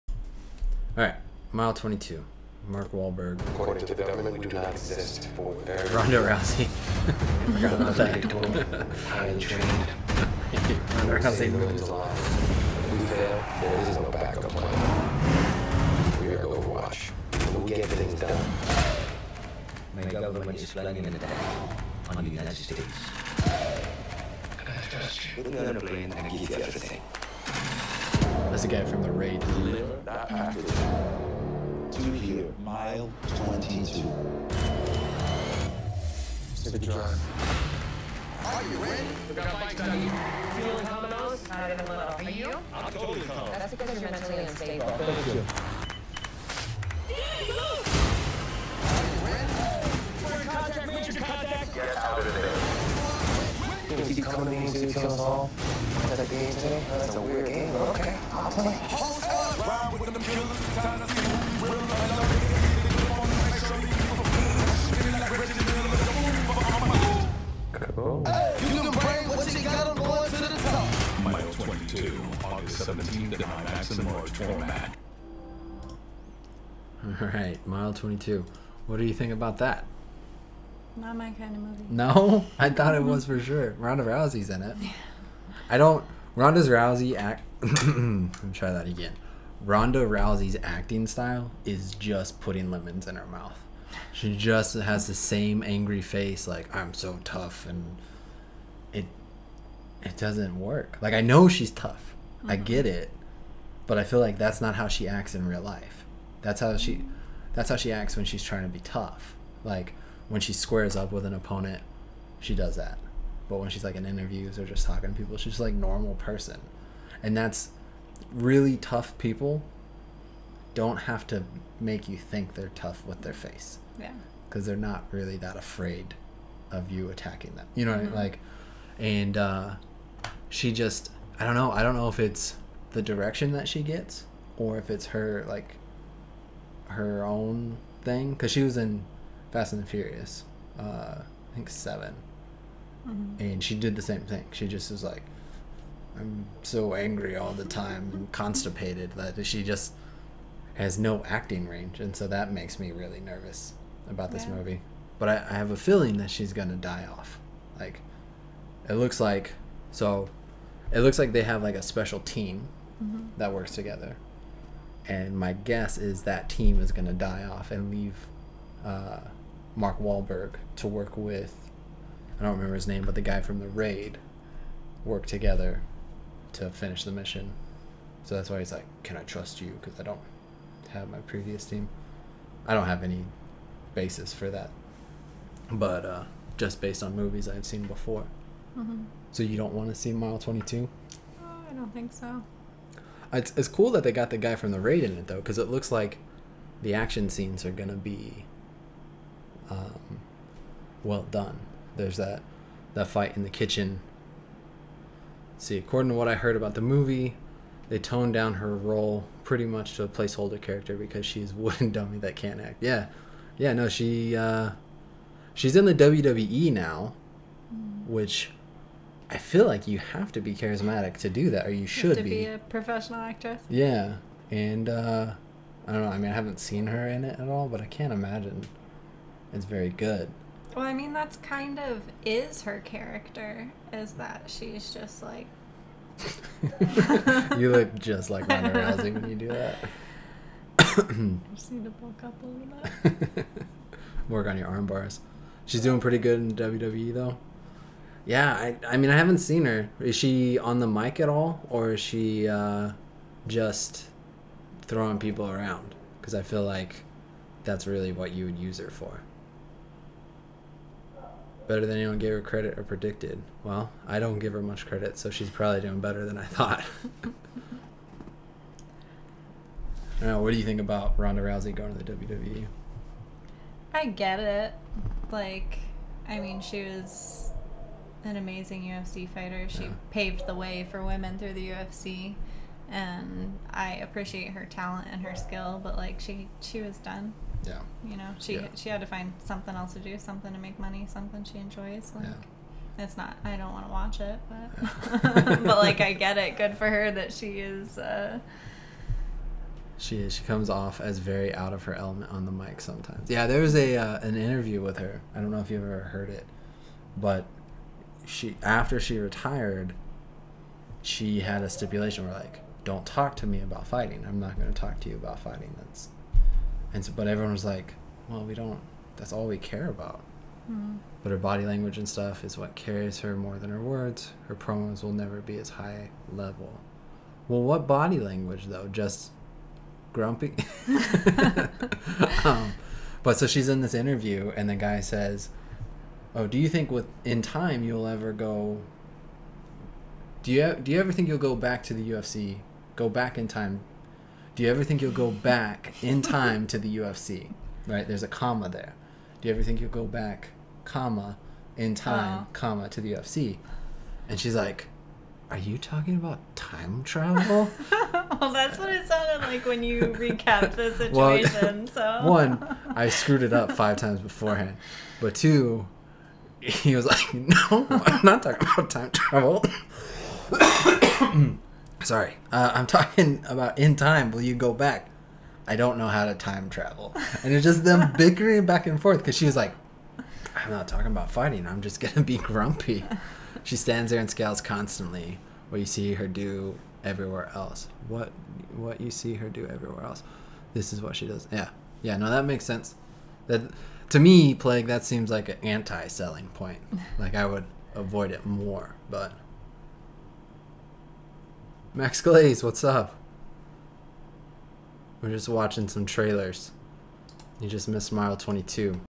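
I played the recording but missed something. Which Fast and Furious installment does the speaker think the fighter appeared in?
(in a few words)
7.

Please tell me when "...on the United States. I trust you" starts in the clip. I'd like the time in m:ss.
0:22.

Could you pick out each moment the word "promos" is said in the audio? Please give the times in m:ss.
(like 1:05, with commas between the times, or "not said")
5:24.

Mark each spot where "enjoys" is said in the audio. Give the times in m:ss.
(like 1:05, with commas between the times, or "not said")
4:51.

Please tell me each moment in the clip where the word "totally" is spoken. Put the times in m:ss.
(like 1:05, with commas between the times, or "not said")
0:42.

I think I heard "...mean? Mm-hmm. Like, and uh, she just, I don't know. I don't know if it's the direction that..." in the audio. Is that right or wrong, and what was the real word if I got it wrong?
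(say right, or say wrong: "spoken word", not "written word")
right.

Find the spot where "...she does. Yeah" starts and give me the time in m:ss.
6:31.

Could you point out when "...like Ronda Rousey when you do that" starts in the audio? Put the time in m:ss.
3:58.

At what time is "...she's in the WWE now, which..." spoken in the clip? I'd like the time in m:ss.
3:35.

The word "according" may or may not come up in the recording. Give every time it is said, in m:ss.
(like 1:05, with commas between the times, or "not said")
0:03, 3:25.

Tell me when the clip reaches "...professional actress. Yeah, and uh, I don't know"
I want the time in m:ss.
3:42.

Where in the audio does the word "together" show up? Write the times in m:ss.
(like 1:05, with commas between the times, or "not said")
2:43, 2:55.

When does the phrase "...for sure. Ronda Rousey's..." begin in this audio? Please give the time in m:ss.
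1:23.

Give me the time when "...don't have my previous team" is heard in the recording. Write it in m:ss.
3:00.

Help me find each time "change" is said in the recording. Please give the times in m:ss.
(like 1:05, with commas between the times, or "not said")
not said.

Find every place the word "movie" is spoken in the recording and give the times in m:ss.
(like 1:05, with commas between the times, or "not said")
1:21, 2:34, 3:07, 3:26.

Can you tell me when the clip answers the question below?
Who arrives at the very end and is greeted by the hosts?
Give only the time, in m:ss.
6:41.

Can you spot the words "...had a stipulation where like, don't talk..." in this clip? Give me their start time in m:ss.
5:11.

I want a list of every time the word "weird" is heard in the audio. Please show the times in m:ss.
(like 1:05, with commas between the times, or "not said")
0:57.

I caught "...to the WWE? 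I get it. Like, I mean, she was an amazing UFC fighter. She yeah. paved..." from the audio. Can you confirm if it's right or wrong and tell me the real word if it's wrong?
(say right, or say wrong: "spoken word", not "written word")
right.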